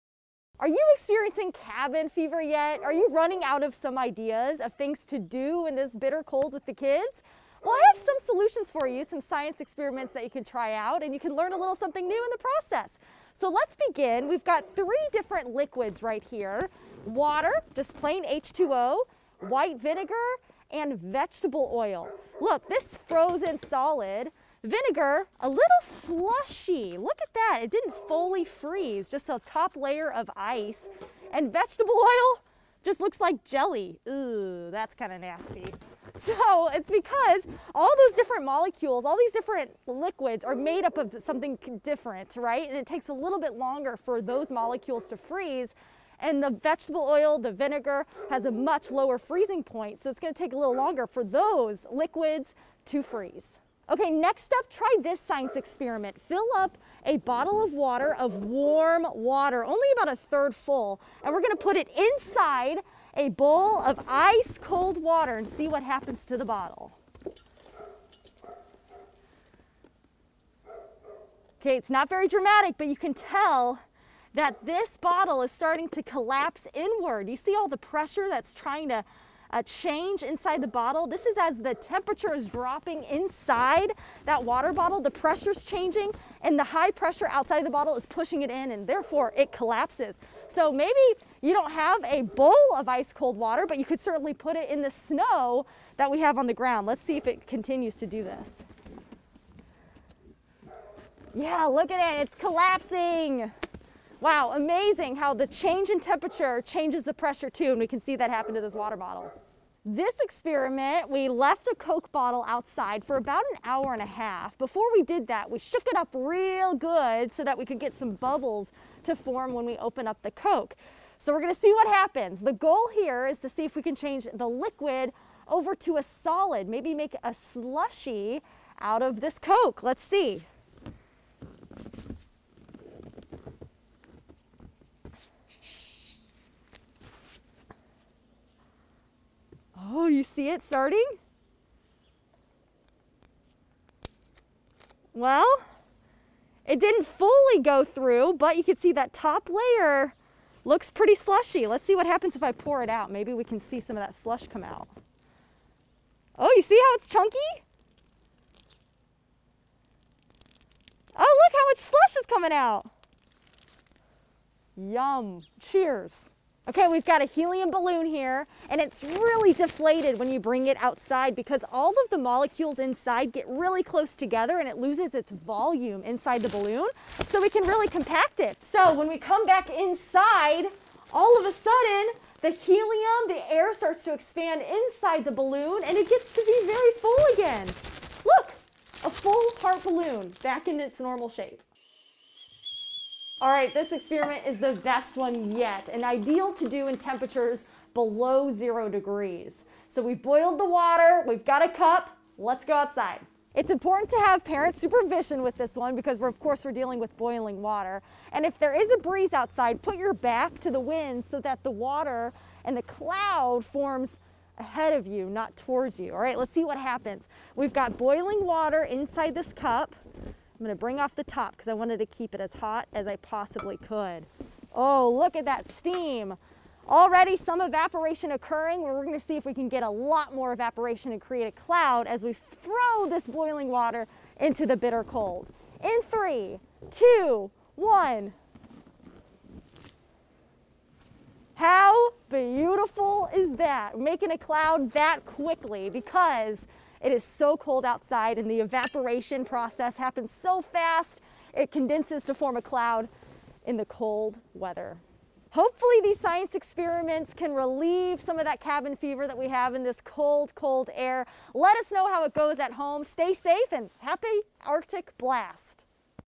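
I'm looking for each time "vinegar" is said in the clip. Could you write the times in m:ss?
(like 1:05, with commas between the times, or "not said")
0:19, 0:24, 0:47.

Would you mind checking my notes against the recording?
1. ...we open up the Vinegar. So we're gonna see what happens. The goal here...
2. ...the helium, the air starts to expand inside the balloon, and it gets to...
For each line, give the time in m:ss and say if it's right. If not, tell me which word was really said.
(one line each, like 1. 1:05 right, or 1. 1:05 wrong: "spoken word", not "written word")
1. 1:59 wrong: "Coke", not "Vinegar"
2. 3:02 right.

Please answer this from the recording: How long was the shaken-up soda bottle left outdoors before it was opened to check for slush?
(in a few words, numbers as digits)
an hour and a half.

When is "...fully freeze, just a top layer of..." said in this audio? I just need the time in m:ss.
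0:28.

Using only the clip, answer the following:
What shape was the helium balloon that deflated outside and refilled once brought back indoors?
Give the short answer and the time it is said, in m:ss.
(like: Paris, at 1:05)
heart, at 3:09.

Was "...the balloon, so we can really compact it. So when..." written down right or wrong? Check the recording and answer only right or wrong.
right.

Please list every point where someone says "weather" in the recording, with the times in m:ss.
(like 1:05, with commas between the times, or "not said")
4:14.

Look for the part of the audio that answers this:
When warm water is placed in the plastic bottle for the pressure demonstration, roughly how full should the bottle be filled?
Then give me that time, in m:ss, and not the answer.
1:00.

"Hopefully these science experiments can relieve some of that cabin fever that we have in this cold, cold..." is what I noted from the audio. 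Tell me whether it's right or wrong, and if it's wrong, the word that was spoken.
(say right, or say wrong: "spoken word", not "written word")
right.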